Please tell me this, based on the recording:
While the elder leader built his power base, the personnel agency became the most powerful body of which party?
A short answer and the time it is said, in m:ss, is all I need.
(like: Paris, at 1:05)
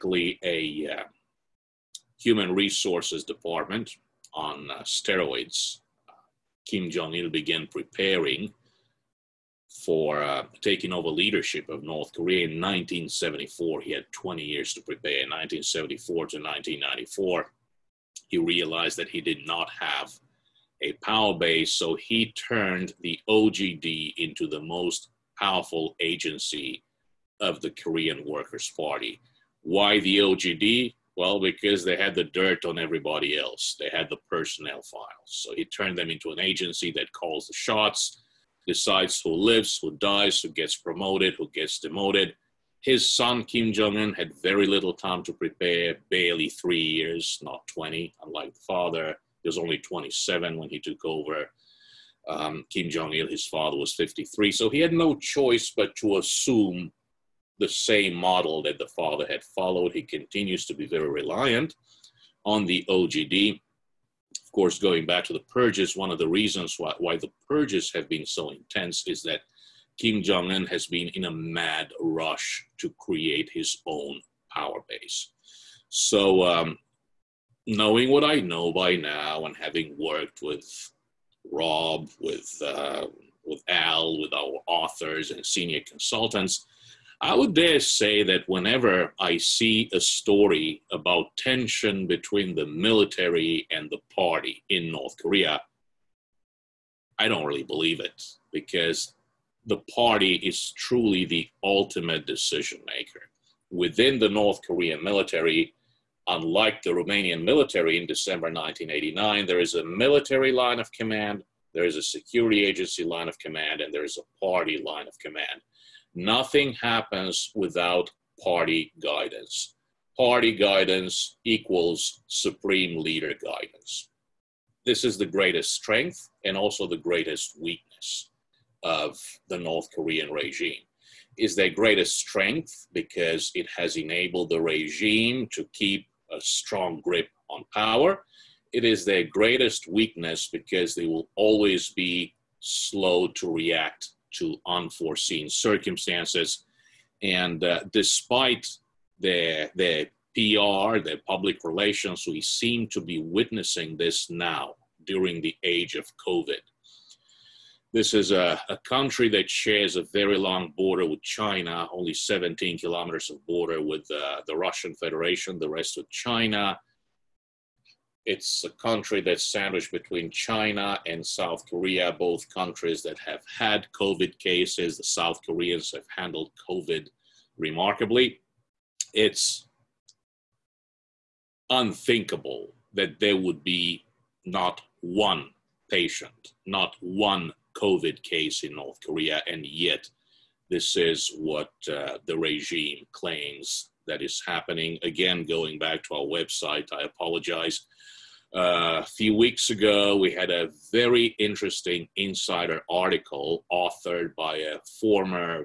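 Korean Workers' Party, at 0:27.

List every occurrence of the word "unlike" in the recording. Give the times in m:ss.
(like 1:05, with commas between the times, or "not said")
0:48, 1:46.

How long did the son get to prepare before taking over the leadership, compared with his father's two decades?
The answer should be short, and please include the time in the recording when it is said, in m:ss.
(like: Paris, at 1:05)
3 years, at 0:46.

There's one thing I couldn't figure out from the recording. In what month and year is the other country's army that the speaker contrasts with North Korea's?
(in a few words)
December 1989.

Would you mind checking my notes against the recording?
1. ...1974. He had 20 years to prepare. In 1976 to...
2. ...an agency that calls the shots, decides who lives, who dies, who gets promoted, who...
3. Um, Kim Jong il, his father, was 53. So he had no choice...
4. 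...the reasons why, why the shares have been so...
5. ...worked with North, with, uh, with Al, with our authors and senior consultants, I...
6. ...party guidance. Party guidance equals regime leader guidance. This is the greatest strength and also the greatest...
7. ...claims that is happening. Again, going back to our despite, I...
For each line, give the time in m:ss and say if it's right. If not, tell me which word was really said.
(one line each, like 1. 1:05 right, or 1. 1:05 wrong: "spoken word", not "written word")
1. 0:12 wrong: "1974", not "1976"
2. 0:36 right
3. 0:52 right
4. 1:06 wrong: "purges", not "shares"
5. 1:19 wrong: "Rob", not "North"
6. 1:58 wrong: "supreme", not "regime"
7. 3:13 wrong: "website", not "despite".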